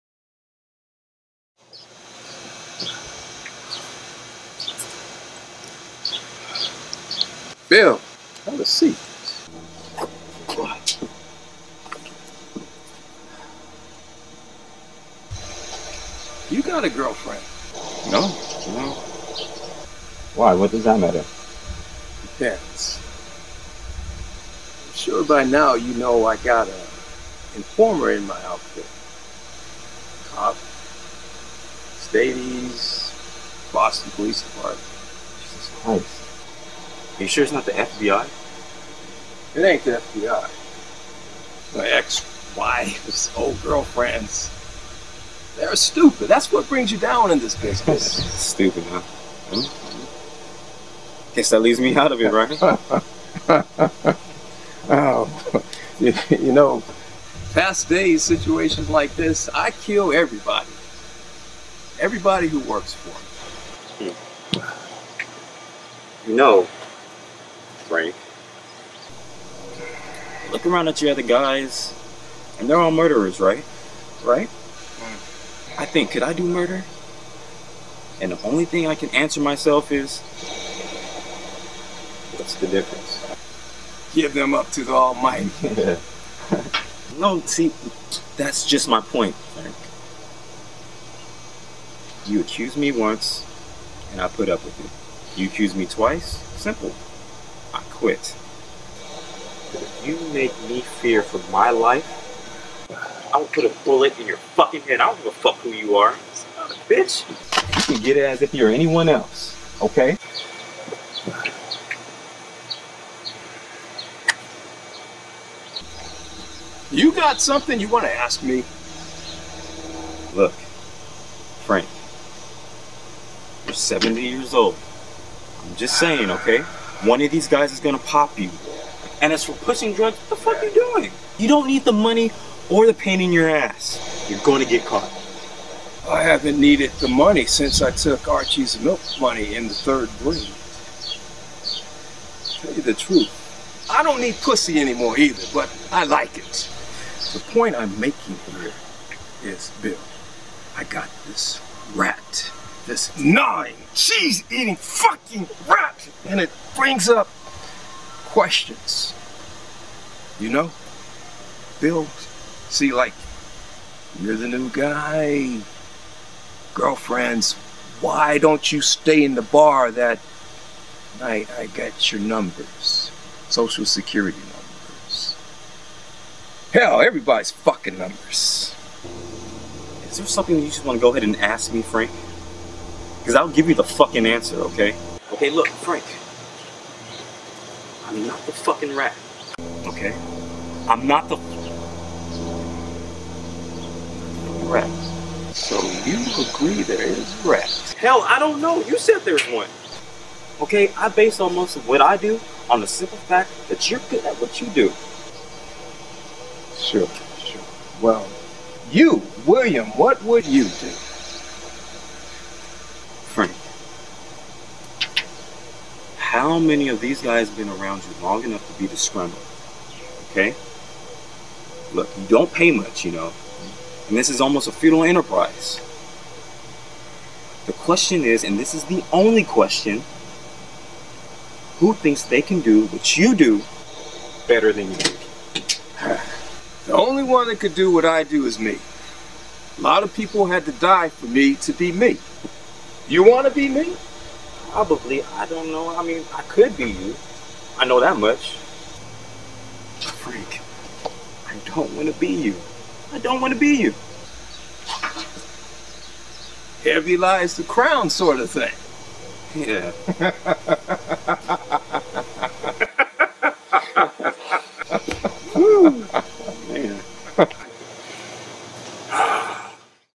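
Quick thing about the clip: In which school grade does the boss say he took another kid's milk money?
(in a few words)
third grade.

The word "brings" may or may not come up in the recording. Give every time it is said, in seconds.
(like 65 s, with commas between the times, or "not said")
46 s, 156 s.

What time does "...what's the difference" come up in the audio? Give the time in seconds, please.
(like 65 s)
82 s.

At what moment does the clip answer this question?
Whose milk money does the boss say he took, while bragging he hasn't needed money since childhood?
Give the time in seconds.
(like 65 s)
138 s.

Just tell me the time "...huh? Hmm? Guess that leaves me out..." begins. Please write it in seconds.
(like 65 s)
48 s.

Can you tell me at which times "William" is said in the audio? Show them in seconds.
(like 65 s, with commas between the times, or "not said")
209 s.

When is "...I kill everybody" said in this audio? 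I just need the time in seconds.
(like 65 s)
59 s.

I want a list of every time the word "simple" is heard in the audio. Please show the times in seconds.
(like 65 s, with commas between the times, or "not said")
96 s, 202 s.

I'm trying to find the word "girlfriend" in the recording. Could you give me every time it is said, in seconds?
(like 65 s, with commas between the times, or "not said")
16 s, 43 s, 166 s.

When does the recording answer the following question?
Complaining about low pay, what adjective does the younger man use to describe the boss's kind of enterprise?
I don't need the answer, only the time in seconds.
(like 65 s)
224 s.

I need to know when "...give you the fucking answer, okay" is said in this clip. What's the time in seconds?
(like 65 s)
183 s.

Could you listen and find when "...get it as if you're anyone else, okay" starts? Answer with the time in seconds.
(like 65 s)
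108 s.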